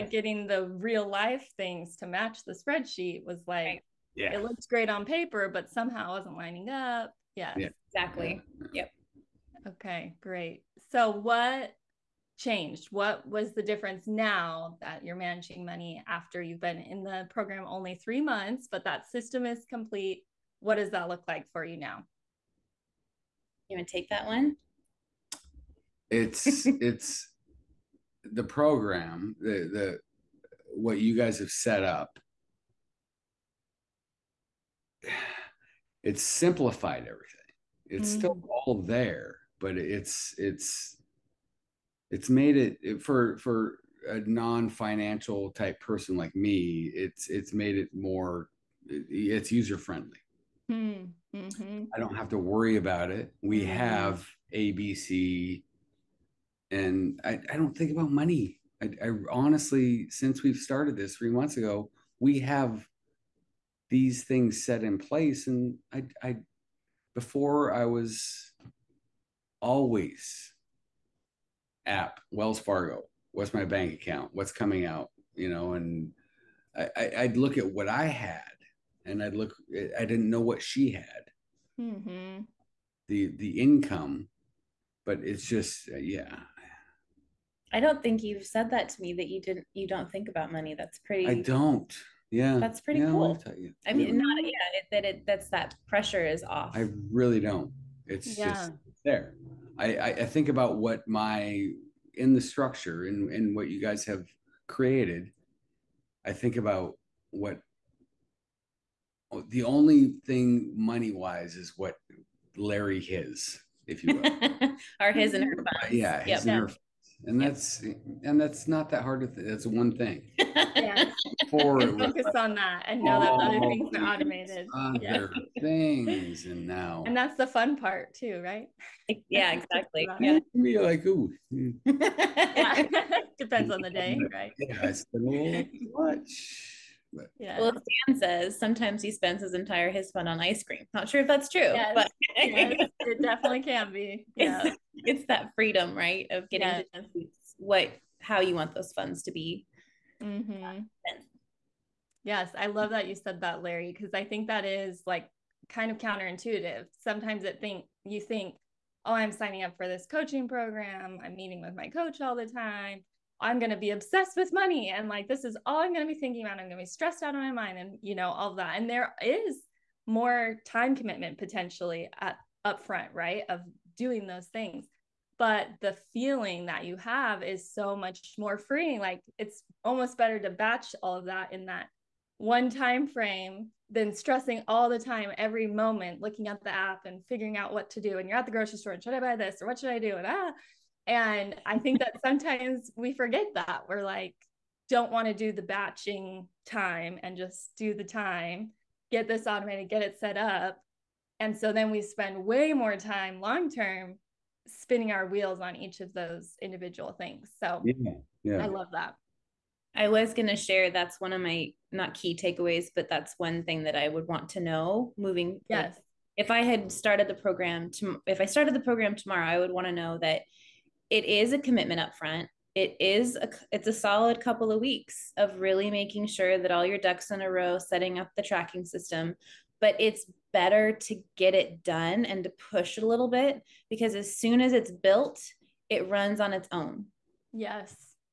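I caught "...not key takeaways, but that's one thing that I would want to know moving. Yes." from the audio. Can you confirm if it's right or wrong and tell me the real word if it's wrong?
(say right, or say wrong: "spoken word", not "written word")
right.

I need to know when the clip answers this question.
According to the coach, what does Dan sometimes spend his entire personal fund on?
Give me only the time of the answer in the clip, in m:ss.
2:20.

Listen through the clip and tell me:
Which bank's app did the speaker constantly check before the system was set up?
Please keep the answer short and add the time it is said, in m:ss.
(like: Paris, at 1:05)
Wells Fargo, at 1:12.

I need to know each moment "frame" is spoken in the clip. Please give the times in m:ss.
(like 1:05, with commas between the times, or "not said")
3:03.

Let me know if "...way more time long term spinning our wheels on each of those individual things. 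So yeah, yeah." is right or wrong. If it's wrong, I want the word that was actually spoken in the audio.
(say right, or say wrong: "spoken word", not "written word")
right.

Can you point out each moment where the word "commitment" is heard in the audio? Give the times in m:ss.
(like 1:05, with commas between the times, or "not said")
2:50, 3:41.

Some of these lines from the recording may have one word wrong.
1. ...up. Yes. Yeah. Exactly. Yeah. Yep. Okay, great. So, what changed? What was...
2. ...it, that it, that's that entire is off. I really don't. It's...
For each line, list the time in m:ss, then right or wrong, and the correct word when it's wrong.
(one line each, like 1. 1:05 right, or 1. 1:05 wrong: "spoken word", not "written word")
1. 0:06 right
2. 1:34 wrong: "pressure", not "entire".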